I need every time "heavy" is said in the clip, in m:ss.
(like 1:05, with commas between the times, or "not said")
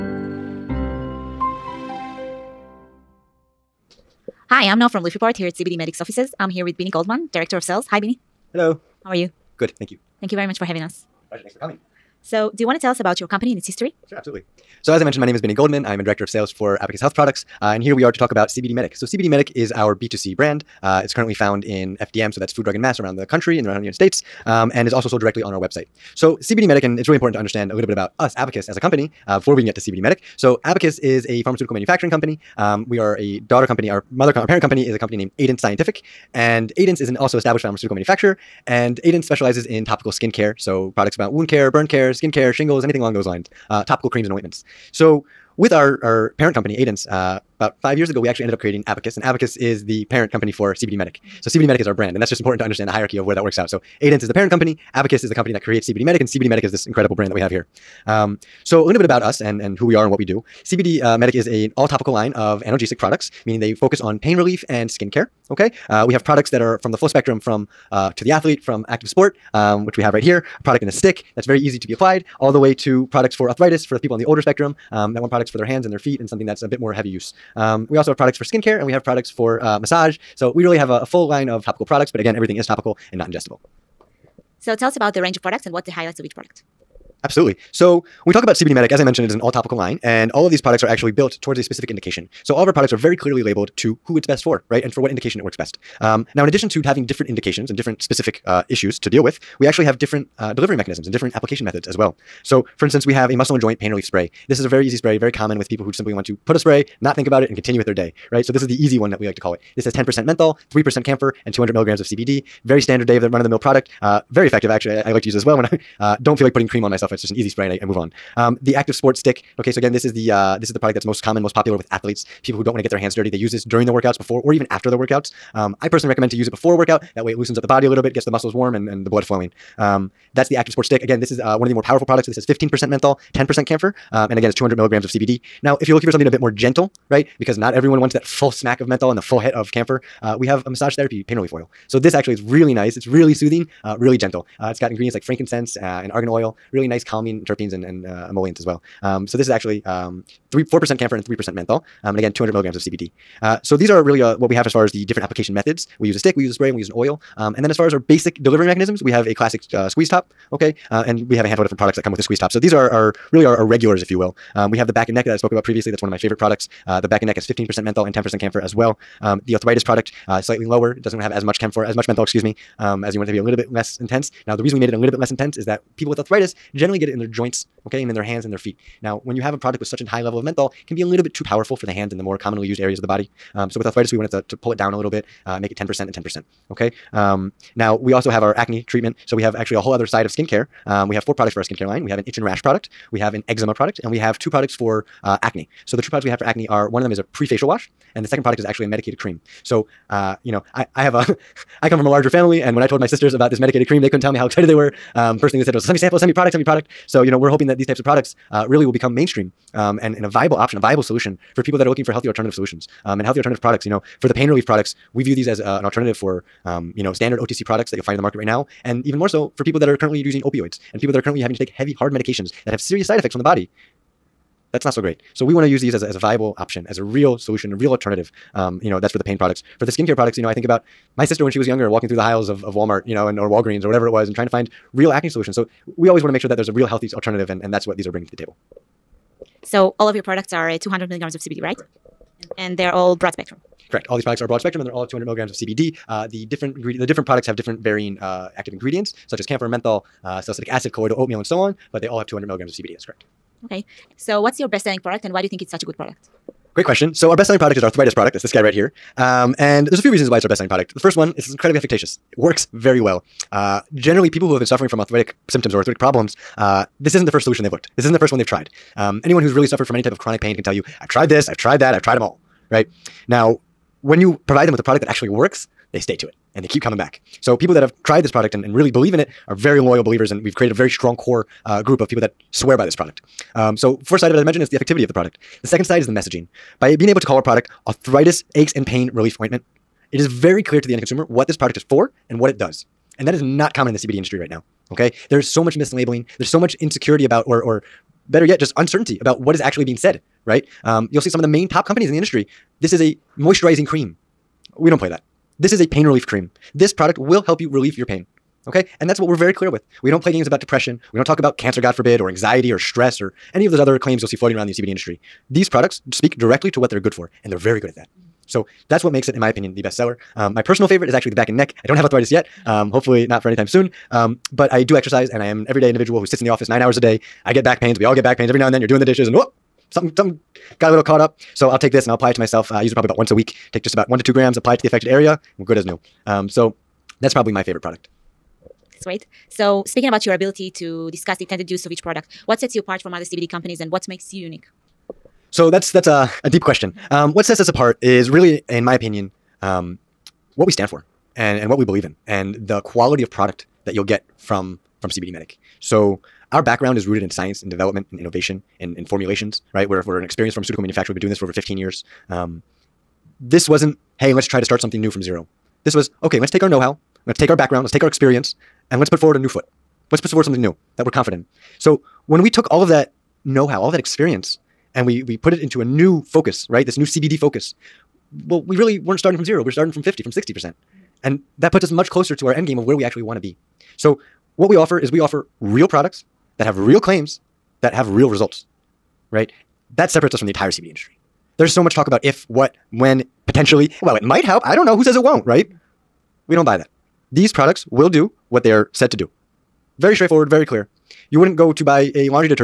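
1:16, 3:41.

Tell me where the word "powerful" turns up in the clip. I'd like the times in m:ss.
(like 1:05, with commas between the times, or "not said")
2:11, 3:01.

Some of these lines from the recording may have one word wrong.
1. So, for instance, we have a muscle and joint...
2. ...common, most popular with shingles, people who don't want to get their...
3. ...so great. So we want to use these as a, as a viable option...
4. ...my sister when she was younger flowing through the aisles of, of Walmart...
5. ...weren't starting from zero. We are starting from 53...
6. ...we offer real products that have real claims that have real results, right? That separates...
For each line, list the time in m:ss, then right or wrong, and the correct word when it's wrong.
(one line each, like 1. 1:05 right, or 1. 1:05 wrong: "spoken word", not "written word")
1. 1:42 right
2. 2:01 wrong: "athletes", not "shingles"
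3. 3:44 right
4. 3:51 wrong: "walking", not "flowing"
5. 6:18 wrong: "50", not "53"
6. 6:25 right.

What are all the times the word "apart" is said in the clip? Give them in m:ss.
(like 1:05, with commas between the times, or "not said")
5:42, 5:47.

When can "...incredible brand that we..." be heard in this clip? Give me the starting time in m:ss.
0:56.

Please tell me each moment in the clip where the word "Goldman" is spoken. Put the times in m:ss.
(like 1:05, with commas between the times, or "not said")
0:06, 0:15.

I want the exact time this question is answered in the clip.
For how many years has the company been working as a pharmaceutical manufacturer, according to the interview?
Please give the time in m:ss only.
6:01.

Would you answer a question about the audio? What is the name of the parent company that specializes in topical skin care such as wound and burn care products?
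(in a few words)
Aidance Scientific.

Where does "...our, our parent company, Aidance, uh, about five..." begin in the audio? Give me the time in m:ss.
0:45.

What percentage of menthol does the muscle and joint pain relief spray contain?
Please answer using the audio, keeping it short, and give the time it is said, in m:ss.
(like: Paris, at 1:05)
10%, at 1:49.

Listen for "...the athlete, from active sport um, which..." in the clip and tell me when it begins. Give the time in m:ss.
1:08.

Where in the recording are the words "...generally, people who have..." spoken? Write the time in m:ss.
4:23.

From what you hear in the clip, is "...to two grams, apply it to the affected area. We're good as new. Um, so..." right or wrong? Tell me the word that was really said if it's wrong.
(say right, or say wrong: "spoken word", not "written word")
right.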